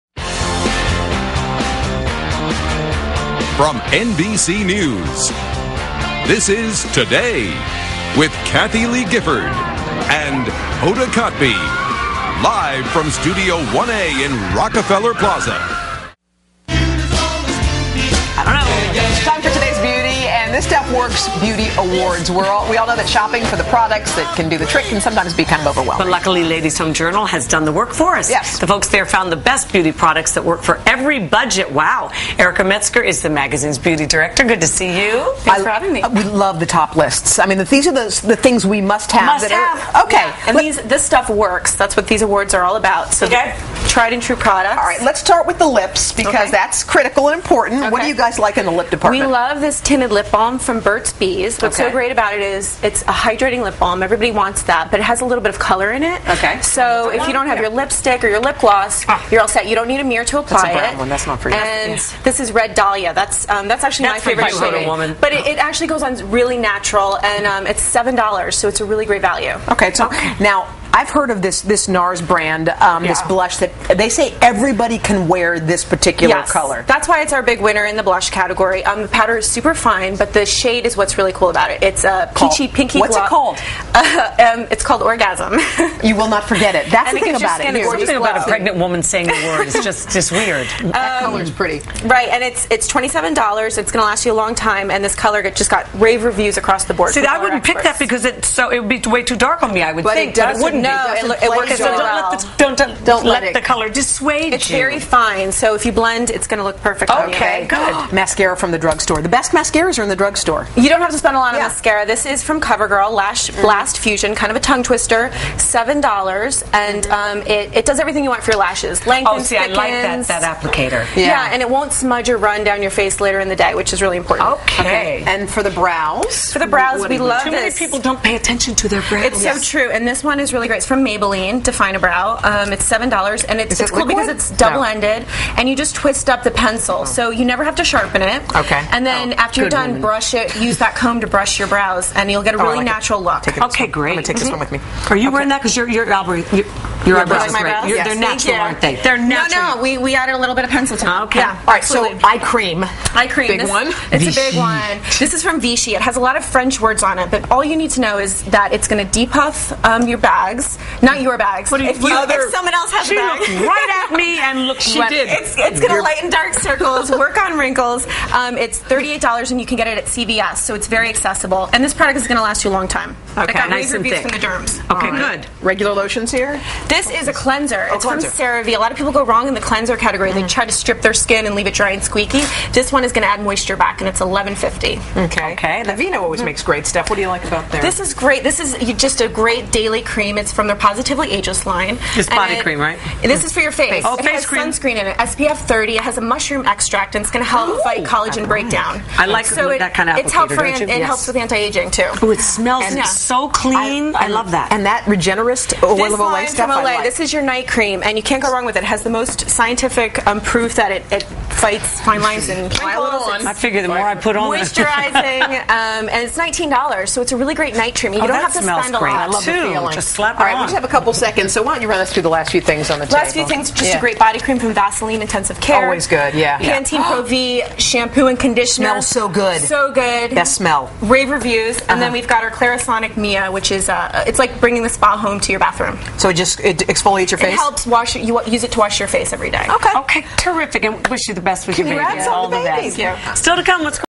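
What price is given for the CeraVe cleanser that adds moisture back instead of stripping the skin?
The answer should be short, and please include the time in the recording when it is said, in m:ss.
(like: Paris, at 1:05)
$11.50, at 3:04.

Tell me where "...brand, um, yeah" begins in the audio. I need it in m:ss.
1:12.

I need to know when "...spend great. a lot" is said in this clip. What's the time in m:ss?
3:38.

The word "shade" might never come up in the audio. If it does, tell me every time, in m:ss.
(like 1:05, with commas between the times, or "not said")
1:04, 1:20.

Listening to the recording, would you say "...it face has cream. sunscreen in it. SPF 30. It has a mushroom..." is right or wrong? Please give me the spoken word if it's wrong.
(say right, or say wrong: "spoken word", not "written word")
right.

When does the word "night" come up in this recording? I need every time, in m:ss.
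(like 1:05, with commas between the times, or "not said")
3:27, 3:37.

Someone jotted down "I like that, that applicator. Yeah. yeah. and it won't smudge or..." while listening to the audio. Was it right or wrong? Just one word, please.
right.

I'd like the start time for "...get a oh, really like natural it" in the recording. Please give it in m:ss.
2:22.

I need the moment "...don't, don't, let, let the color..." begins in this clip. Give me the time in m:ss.
1:42.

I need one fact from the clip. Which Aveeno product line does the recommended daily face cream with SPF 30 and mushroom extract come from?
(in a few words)
Positively Ageless.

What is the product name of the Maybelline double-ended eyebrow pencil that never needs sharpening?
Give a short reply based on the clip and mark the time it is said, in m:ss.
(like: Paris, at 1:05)
Define a Brow, at 2:11.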